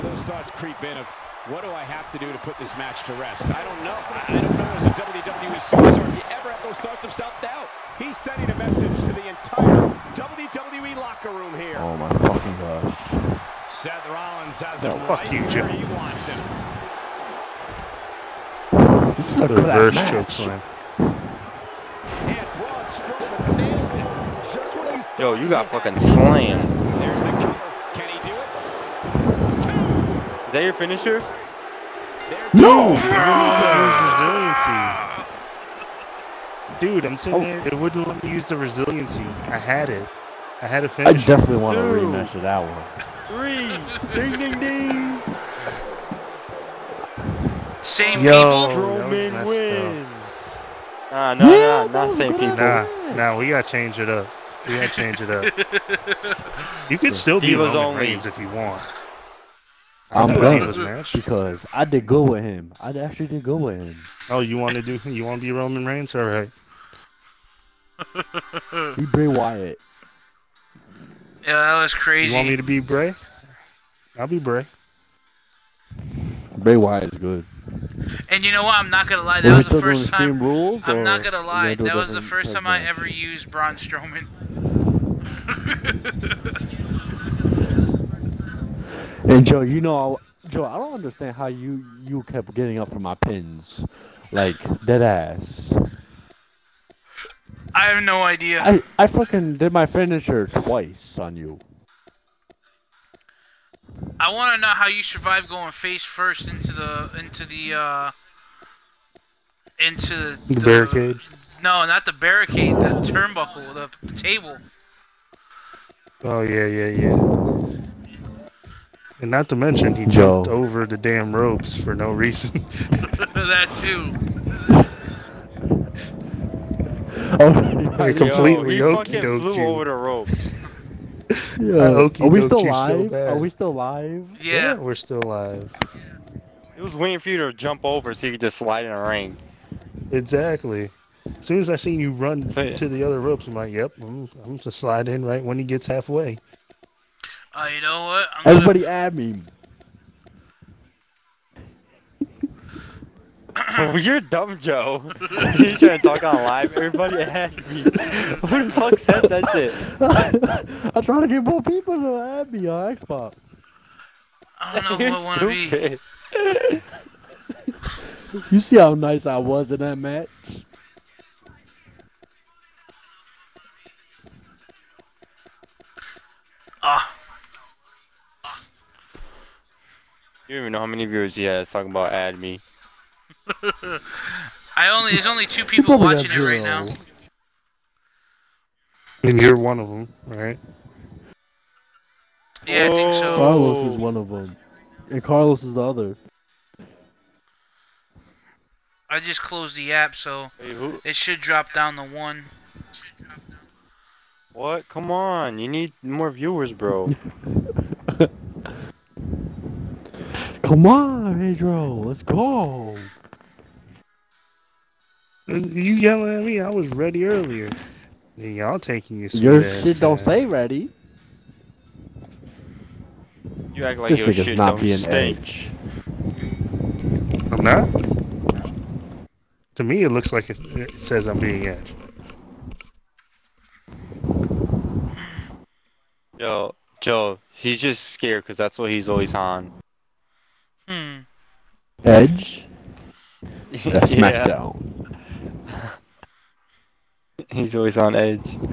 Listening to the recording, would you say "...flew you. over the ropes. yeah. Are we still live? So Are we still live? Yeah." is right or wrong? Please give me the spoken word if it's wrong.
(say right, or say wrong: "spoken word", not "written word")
right.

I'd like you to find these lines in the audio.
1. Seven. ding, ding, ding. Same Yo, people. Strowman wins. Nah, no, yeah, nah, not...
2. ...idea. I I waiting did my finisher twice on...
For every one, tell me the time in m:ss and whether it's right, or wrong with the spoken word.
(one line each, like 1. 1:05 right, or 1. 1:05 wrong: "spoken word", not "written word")
1. 0:44 wrong: "Three", not "Seven"
2. 1:38 wrong: "fucking", not "waiting".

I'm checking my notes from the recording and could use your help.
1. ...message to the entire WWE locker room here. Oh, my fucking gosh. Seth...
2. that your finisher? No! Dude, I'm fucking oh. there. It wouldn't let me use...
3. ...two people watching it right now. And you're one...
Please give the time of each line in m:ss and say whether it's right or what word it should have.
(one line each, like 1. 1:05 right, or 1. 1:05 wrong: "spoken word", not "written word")
1. 0:08 right
2. 0:30 wrong: "sitting", not "fucking"
3. 3:05 right.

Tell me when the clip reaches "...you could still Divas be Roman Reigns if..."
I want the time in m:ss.
0:56.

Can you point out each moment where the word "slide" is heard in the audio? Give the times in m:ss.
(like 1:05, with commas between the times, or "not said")
2:18, 2:24.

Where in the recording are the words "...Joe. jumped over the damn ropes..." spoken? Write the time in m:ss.
2:00.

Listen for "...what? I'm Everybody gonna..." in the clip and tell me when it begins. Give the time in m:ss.
2:28.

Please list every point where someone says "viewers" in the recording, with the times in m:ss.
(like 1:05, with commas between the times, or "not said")
3:01, 3:26.